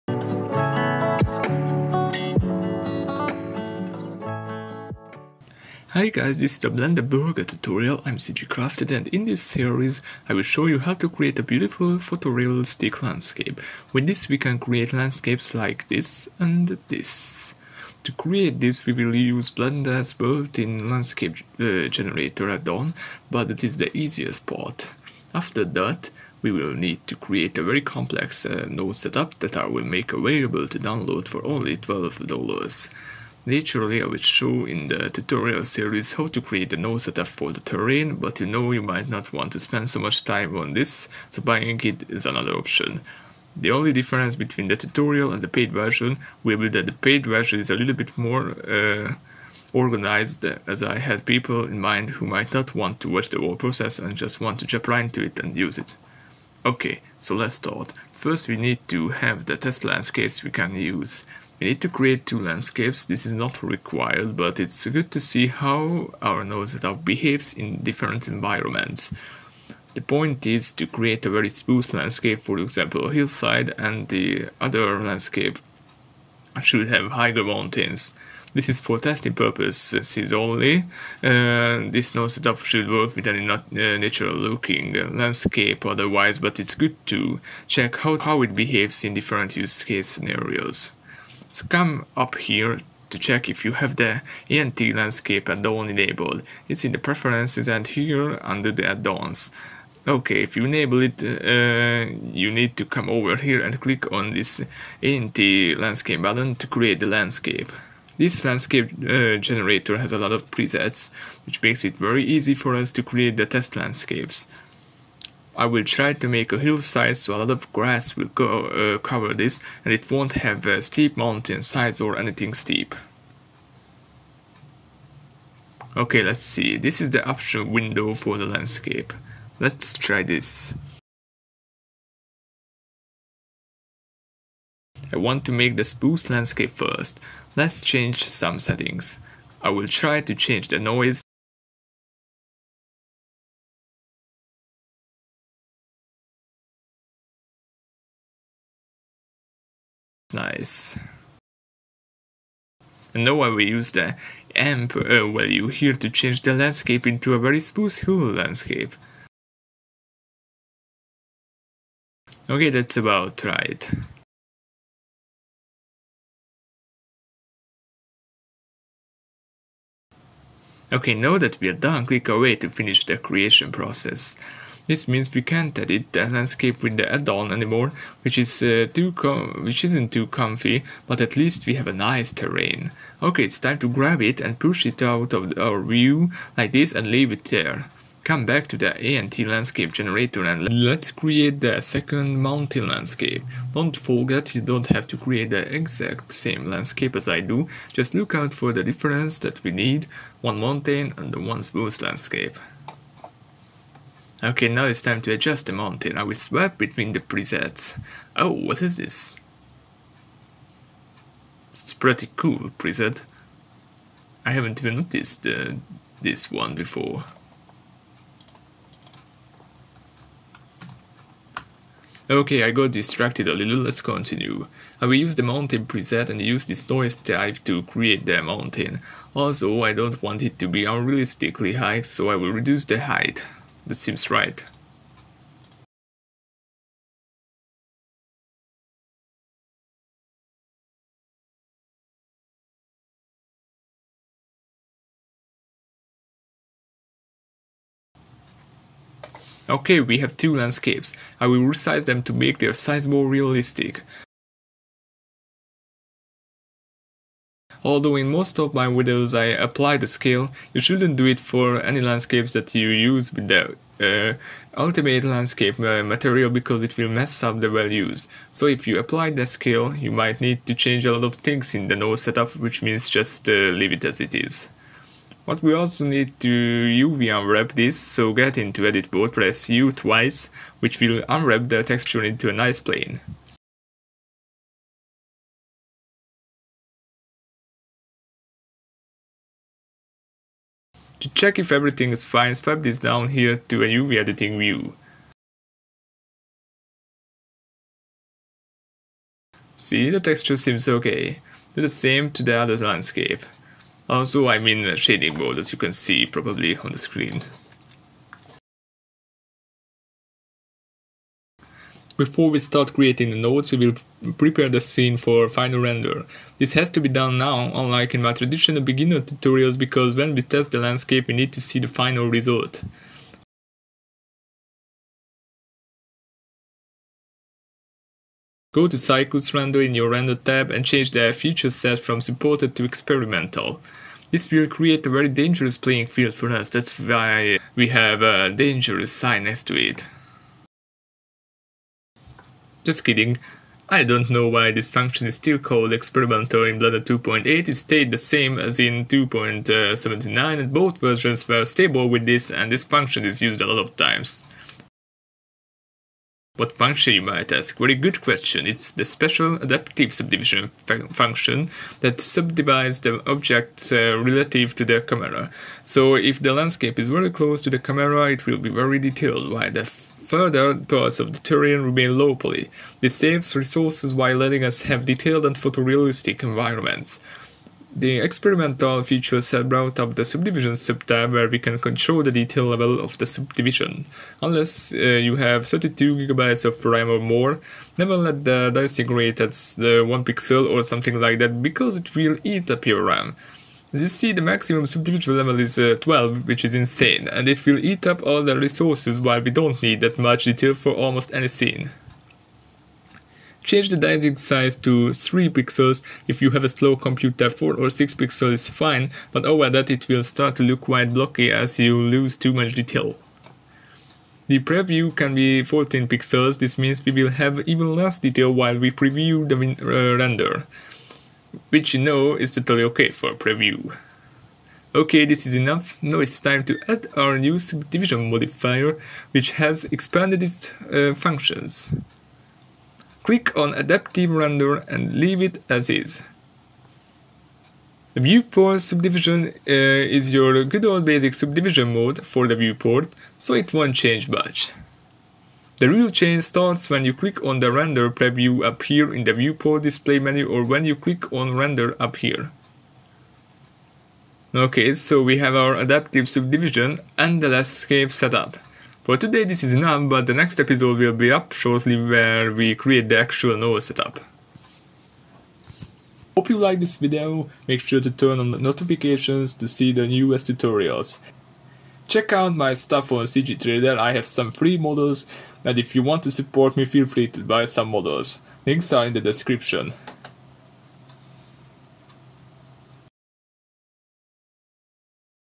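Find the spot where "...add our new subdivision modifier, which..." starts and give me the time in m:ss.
7:06.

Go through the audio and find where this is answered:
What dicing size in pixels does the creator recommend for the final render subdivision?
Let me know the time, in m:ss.
6:45.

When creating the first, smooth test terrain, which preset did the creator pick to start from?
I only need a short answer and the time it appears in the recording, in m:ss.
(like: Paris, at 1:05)
spruce, at 2:15.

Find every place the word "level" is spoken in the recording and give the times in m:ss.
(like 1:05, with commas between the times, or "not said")
6:22, 6:35.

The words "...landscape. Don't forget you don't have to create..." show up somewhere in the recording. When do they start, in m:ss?
3:12.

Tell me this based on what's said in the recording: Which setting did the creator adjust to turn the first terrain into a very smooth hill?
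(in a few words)
amp.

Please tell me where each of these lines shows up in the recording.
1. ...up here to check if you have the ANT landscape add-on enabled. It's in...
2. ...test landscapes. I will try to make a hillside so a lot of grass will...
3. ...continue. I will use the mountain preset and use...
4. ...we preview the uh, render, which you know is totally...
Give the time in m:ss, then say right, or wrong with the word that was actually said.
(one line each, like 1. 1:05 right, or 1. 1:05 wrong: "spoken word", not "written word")
1. 1:32 right
2. 1:53 right
3. 3:43 right
4. 6:58 right.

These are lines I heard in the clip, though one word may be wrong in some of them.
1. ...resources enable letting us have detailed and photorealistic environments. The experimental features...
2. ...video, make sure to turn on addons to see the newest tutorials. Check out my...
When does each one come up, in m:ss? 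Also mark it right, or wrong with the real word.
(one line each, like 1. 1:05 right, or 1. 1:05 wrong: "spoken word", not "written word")
1. 6:13 wrong: "while", not "enable"
2. 7:46 wrong: "notifications", not "addons".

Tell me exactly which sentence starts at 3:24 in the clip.
Okay, now it's time to adjust the mountain, I will swap between the presets.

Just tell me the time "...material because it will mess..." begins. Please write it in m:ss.
4:26.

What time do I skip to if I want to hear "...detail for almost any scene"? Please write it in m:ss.
6:40.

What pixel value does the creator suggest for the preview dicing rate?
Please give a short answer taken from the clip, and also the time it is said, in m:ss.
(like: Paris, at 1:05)
14 pixels, at 6:55.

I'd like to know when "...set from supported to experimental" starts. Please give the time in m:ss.
5:31.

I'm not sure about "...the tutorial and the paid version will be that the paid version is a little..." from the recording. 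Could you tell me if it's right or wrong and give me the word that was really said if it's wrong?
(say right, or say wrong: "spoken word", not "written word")
right.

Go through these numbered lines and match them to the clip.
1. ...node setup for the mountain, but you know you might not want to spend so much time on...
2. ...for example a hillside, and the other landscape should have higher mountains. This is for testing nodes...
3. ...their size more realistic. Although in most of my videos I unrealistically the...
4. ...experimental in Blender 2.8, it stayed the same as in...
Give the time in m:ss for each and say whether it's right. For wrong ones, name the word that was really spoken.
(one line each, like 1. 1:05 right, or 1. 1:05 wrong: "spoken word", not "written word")
1. 0:36 wrong: "terrain", not "mountain"
2. 1:12 wrong: "purposes", not "nodes"
3. 4:12 wrong: "apply", not "unrealistically"
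4. 5:45 right.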